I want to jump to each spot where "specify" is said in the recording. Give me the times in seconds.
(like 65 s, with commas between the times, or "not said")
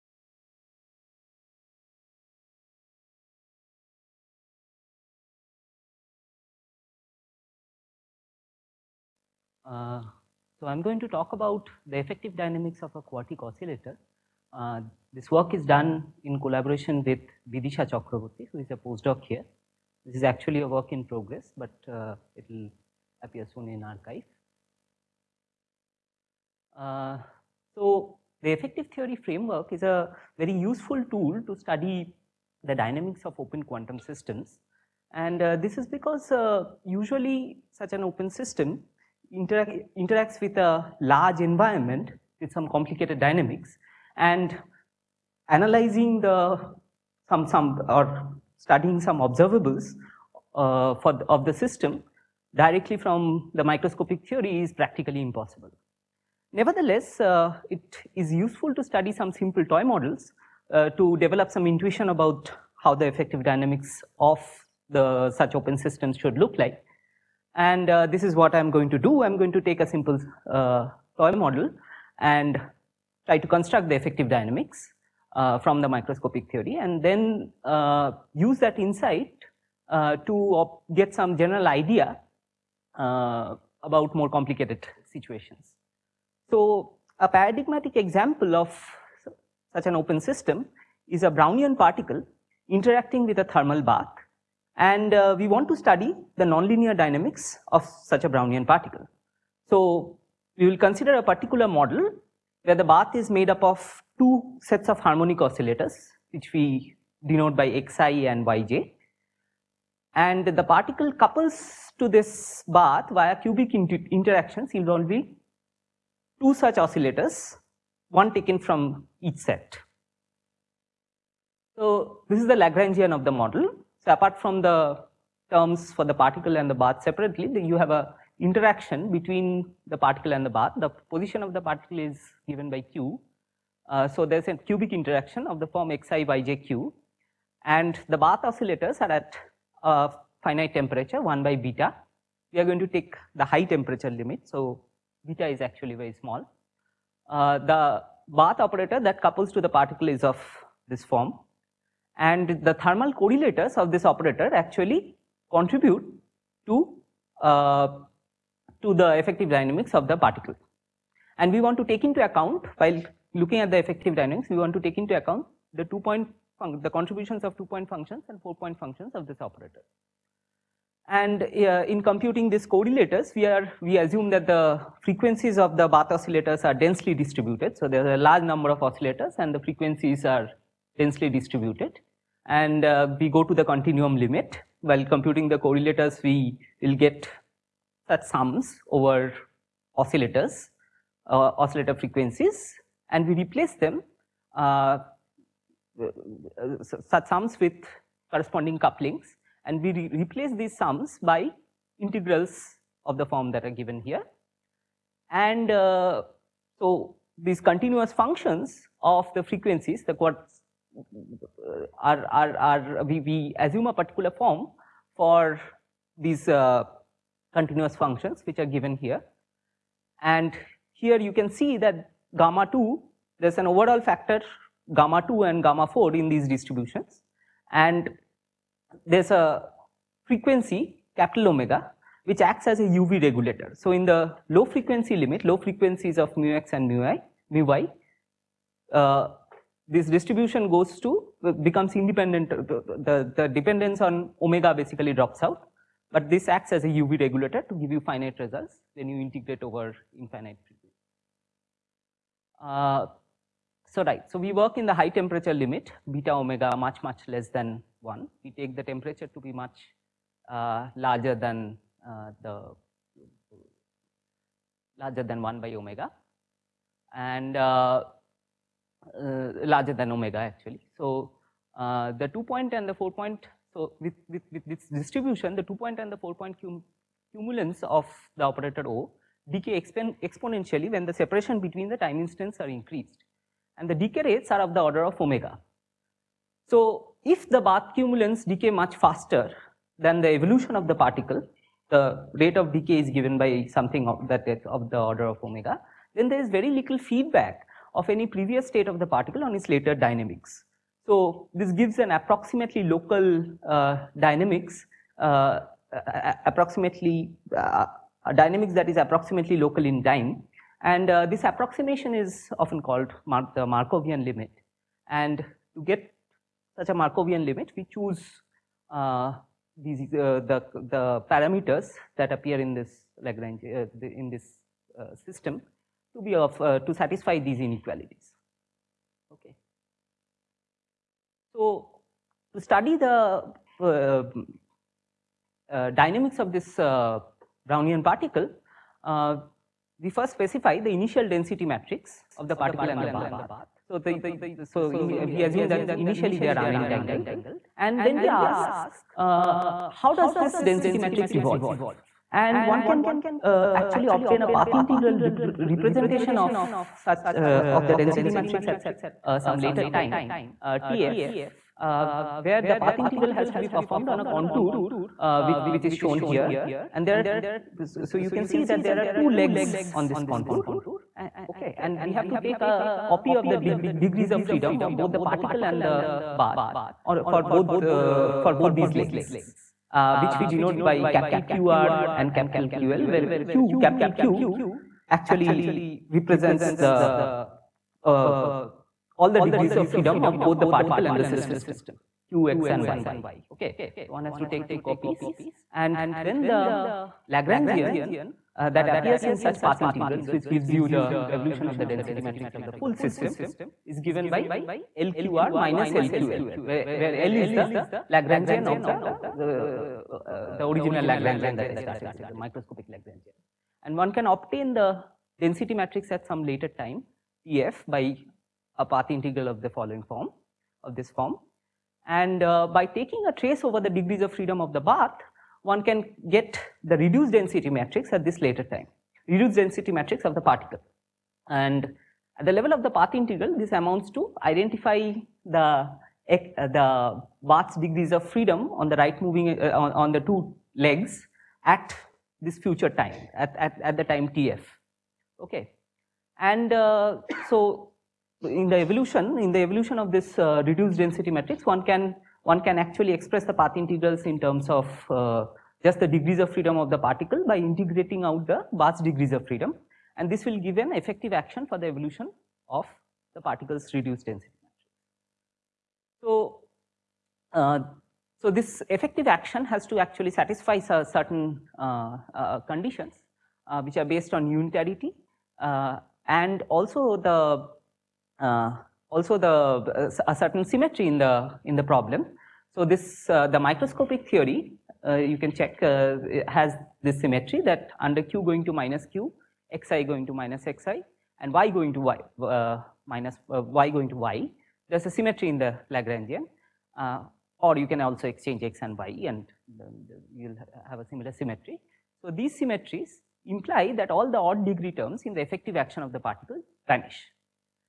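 340 s.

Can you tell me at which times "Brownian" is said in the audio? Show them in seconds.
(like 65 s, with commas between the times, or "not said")
91 s, 98 s, 337 s.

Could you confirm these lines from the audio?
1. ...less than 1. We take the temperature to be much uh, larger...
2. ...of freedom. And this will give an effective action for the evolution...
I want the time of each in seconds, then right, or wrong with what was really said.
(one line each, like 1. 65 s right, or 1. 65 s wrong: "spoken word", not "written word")
1. 257 s right
2. 459 s right.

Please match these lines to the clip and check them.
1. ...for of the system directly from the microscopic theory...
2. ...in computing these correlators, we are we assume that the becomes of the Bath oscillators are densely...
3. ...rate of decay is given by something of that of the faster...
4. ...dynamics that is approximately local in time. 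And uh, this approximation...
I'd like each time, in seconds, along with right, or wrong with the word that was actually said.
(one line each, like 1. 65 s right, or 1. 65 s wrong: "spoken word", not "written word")
1. 50 s right
2. 171 s wrong: "frequencies", not "becomes"
3. 292 s wrong: "order", not "faster"
4. 308 s right.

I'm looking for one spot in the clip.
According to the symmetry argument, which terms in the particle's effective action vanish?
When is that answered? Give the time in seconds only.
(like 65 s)
504 s.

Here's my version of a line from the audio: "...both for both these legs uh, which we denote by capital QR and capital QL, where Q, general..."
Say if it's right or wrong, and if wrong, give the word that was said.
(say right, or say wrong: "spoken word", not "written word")
wrong: "capital", not "general".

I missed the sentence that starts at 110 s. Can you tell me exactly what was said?
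And the particle couples to this bath via cubic interactions involving two such oscillators, one taken from each set.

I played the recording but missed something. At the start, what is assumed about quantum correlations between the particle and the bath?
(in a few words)
unentangled.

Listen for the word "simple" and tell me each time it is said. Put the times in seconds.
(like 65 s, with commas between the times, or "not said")
59 s, 69 s.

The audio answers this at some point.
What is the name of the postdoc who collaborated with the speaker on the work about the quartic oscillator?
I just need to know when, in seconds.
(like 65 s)
17 s.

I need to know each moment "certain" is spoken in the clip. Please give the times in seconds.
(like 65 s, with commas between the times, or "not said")
470 s, 480 s.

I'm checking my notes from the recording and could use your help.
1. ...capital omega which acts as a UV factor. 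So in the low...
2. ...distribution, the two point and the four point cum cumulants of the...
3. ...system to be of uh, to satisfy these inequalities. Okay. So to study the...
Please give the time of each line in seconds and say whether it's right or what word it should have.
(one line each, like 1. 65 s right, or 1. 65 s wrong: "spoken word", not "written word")
1. 231 s wrong: "regulator", not "factor"
2. 274 s right
3. 325 s right.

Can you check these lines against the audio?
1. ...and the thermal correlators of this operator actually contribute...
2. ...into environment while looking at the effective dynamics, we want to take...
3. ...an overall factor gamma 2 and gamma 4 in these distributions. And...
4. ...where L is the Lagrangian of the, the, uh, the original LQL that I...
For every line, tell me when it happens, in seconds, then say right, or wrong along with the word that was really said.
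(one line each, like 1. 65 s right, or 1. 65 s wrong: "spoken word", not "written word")
1. 152 s right
2. 162 s wrong: "account", not "environment"
3. 223 s right
4. 406 s wrong: "Lagrangian", not "LQL".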